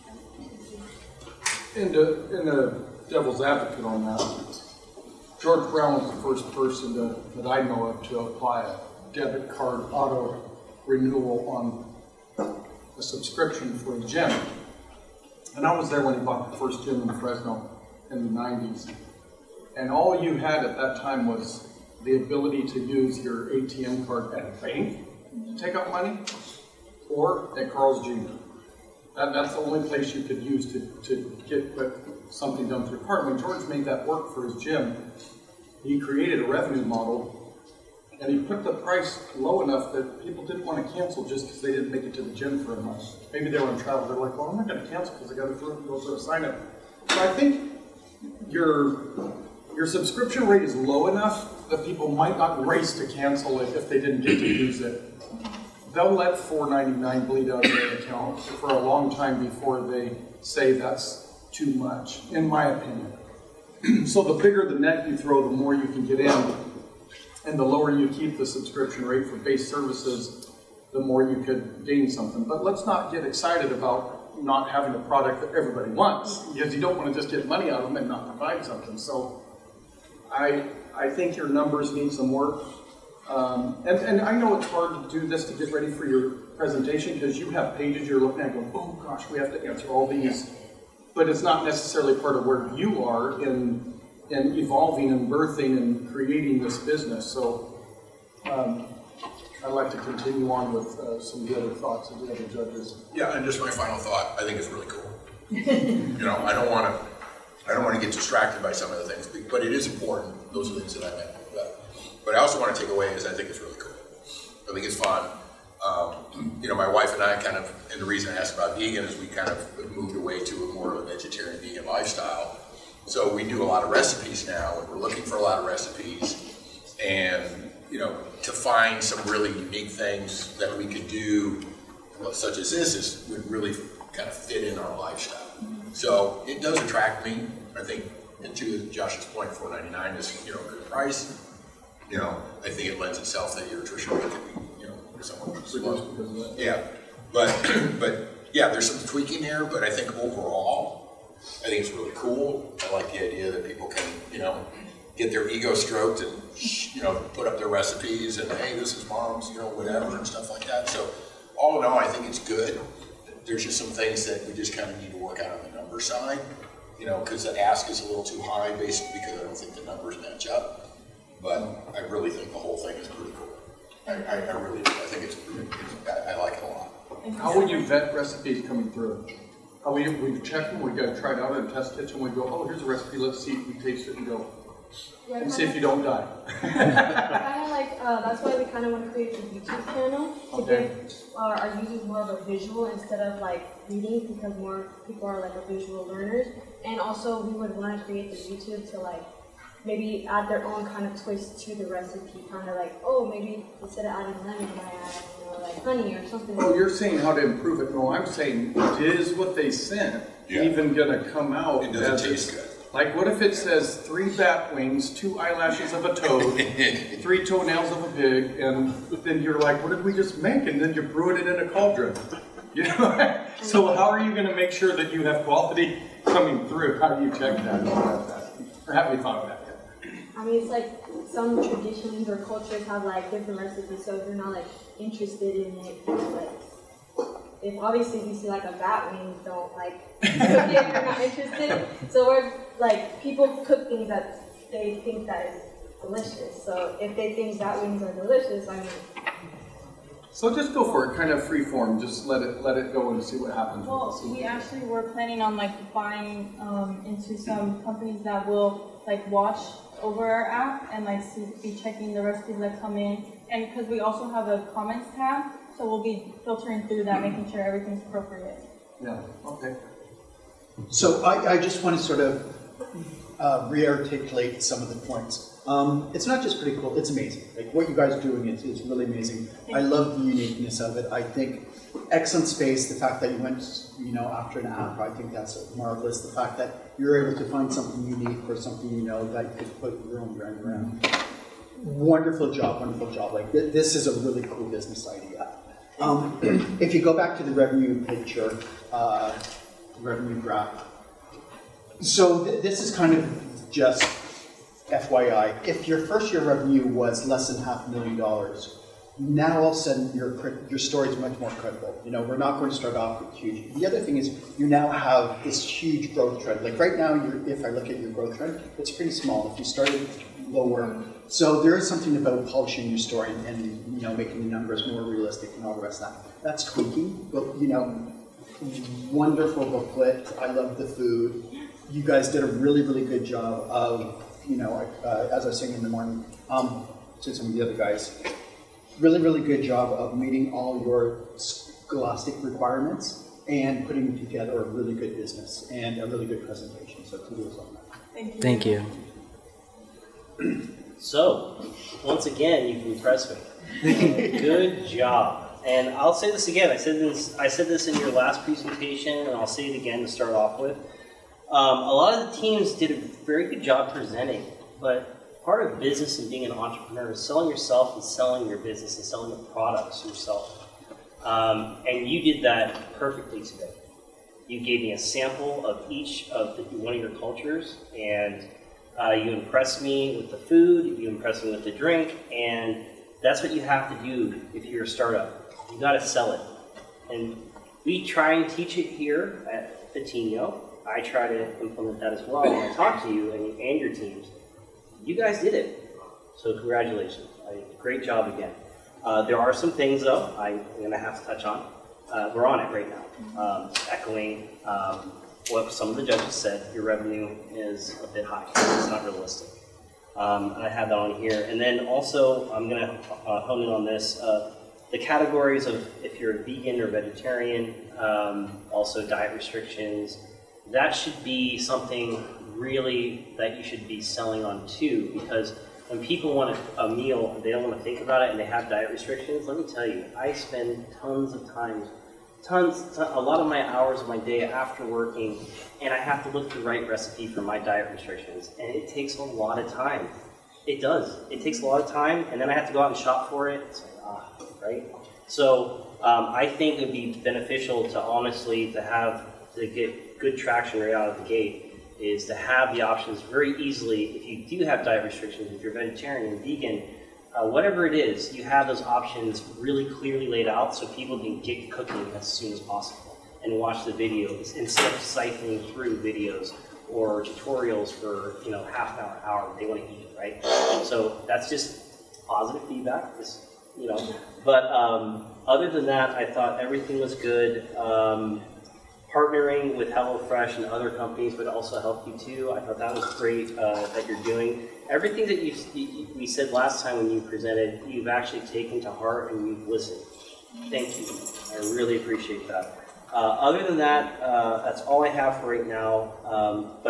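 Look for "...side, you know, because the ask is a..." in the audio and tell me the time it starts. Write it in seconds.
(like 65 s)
165 s.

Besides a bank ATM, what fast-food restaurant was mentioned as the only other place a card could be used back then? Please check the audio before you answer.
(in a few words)
Carl's Jr.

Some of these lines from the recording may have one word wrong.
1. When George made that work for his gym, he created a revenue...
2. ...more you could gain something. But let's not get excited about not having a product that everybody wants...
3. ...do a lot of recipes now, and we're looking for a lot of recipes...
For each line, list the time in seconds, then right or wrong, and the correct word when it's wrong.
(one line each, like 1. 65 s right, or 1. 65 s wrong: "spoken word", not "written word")
1. 33 s right
2. 70 s right
3. 123 s right.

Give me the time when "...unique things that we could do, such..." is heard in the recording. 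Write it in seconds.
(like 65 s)
129 s.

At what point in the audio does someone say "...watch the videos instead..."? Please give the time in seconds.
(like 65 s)
463 s.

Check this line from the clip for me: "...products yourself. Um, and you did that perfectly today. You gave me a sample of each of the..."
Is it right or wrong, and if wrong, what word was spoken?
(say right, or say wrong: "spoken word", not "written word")
right.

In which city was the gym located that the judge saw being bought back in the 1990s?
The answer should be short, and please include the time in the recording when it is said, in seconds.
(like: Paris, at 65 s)
Fresno, at 17 s.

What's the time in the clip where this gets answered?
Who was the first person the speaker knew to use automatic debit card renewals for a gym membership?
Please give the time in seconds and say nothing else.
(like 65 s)
5 s.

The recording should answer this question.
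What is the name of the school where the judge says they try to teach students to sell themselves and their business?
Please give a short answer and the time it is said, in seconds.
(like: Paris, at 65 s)
Patiño, at 389 s.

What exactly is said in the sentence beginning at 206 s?
Oh, you're saying how to improve it.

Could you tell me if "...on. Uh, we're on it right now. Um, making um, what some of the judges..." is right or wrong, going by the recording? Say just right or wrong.
wrong.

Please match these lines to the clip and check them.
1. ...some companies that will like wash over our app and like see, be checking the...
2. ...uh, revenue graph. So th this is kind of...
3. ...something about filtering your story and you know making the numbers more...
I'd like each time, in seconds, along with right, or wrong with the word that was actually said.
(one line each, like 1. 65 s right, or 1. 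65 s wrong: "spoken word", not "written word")
1. 257 s right
2. 298 s right
3. 321 s wrong: "polishing", not "filtering".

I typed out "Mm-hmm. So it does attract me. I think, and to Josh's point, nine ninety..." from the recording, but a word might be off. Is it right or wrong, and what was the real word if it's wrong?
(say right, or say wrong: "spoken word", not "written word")
wrong: "four", not "nine".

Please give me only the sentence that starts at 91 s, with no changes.
But it's not necessarily part of where you are in and evolving and birthing and creating this business.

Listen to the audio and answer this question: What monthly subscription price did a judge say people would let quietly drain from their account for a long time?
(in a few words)
$4.99.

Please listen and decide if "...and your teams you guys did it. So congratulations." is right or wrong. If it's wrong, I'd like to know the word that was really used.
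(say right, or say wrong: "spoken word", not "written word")
right.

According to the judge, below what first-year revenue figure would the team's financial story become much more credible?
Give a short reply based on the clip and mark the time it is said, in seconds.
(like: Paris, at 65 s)
half a million dollars, at 307 s.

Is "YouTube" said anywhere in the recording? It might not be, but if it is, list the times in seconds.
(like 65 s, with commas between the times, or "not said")
189 s, 198 s.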